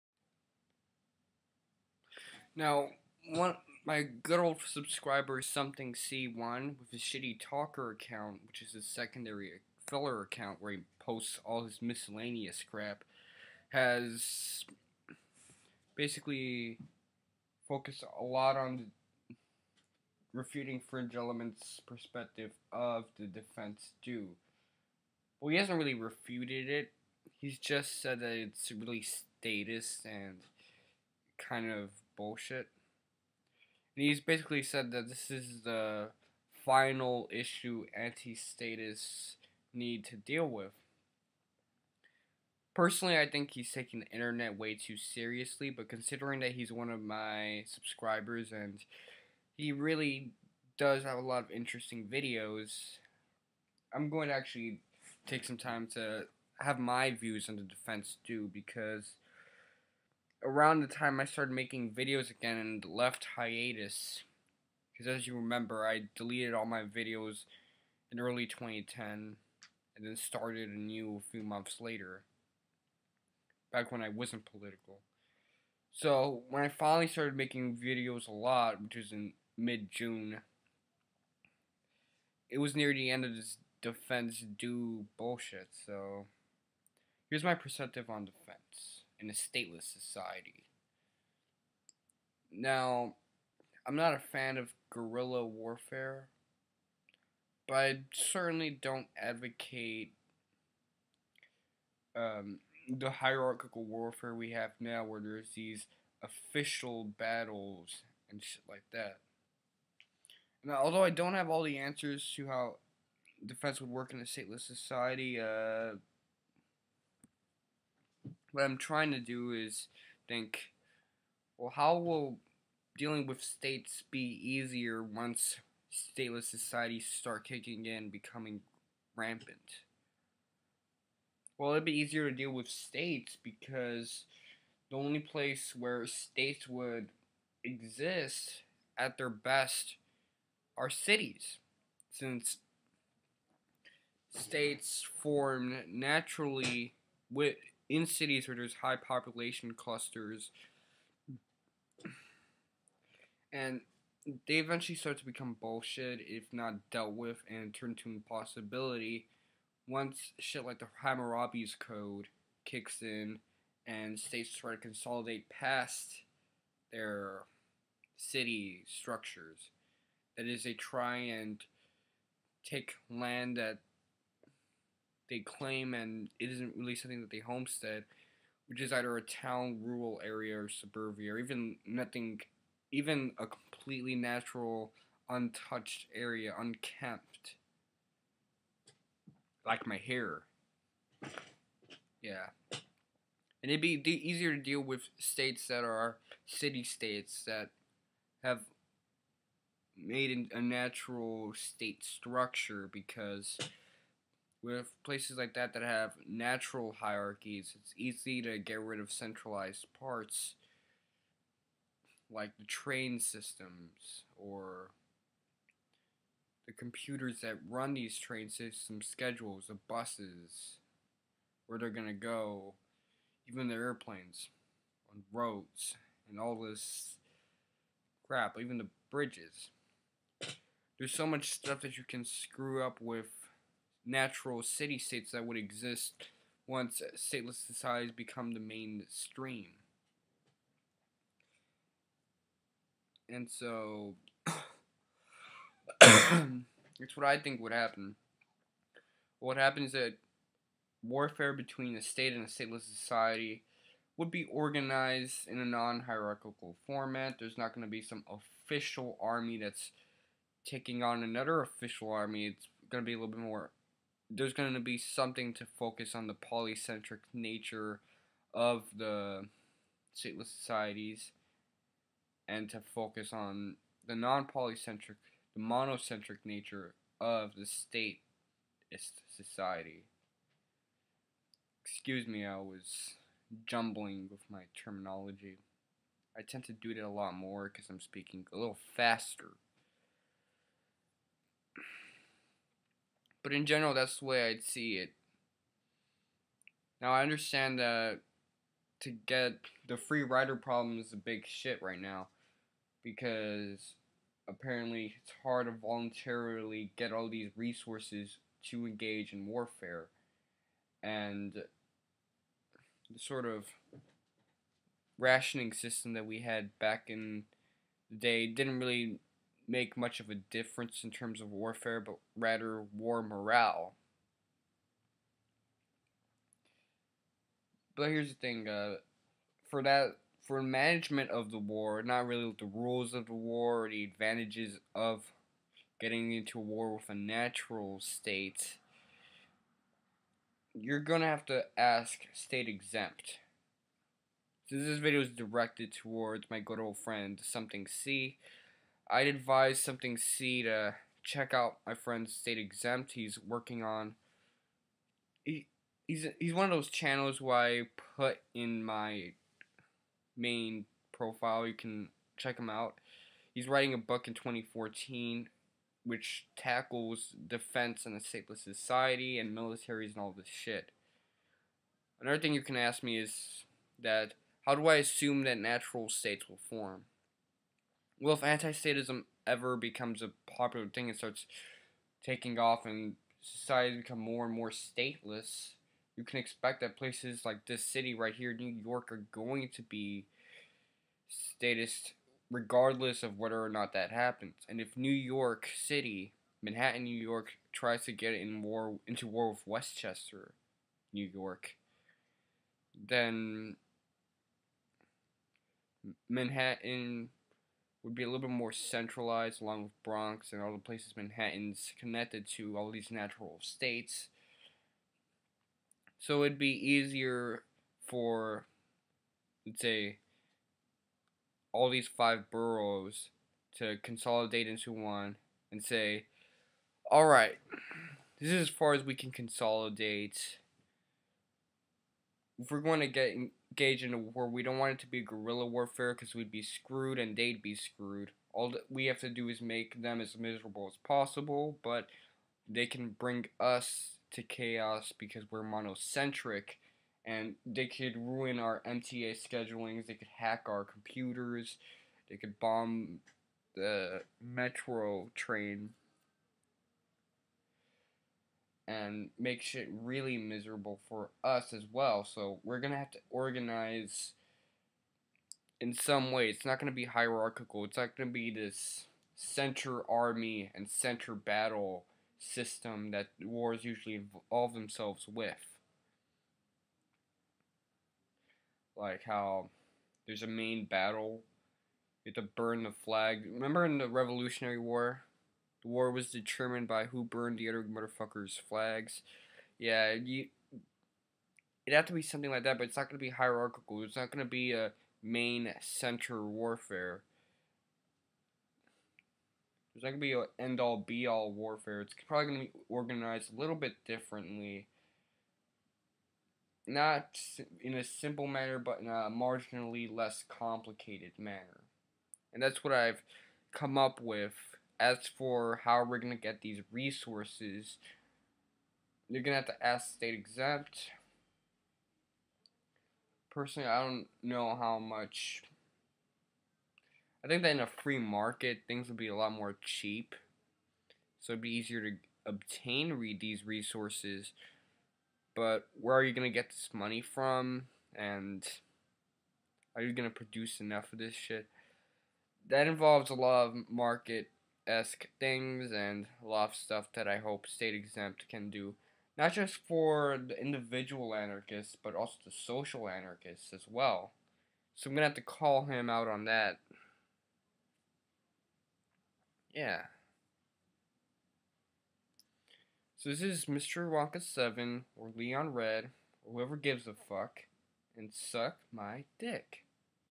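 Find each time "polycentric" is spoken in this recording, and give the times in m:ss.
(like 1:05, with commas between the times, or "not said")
4:26, 4:34.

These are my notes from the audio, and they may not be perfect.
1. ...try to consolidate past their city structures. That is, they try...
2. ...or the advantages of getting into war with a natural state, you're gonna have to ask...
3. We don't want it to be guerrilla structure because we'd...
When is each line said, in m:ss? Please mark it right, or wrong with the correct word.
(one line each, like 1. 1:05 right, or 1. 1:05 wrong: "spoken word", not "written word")
1. 2:44 right
2. 5:33 right
3. 7:14 wrong: "warfare", not "structure".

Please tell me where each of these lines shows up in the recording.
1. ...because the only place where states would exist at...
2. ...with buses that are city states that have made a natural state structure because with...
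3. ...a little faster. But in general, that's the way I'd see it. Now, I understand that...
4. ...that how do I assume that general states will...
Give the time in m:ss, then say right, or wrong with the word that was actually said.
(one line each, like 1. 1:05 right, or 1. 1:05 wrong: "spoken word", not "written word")
1. 2:13 right
2. 3:14 wrong: "states", not "buses"
3. 4:48 right
4. 6:14 wrong: "natural", not "general".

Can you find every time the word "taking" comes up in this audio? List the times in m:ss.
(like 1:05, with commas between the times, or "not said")
0:43, 4:20, 6:22.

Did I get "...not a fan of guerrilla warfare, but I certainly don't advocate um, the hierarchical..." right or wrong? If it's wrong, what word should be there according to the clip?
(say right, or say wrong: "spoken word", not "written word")
right.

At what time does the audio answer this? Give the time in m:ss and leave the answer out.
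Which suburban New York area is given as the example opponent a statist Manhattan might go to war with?
6:39.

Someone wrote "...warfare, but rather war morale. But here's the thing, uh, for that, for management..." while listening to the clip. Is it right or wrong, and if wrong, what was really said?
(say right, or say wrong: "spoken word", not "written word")
right.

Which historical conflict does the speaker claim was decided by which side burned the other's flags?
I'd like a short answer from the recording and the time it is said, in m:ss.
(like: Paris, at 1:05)
Revolutionary War, at 8:04.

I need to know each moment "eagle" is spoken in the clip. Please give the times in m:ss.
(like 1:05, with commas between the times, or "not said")
not said.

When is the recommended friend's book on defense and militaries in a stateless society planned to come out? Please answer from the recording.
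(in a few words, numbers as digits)
2014.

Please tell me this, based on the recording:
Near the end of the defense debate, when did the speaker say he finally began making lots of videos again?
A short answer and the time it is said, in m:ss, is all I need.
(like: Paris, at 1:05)
mid-June, at 1:19.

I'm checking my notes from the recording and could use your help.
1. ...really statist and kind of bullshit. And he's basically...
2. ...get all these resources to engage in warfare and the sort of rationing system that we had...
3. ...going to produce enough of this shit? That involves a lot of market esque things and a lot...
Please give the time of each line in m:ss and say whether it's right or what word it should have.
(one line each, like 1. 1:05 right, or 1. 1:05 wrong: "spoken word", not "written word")
1. 0:28 right
2. 5:06 right
3. 9:00 right.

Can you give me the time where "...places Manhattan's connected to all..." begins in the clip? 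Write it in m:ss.
6:50.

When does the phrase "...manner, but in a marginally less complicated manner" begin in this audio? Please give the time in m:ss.
8:28.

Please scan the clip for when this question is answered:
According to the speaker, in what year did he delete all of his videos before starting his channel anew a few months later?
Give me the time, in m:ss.
1:08.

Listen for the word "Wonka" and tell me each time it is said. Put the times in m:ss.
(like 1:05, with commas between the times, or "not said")
9:24.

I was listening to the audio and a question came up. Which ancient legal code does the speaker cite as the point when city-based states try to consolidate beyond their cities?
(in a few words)
Hammurabi's Code.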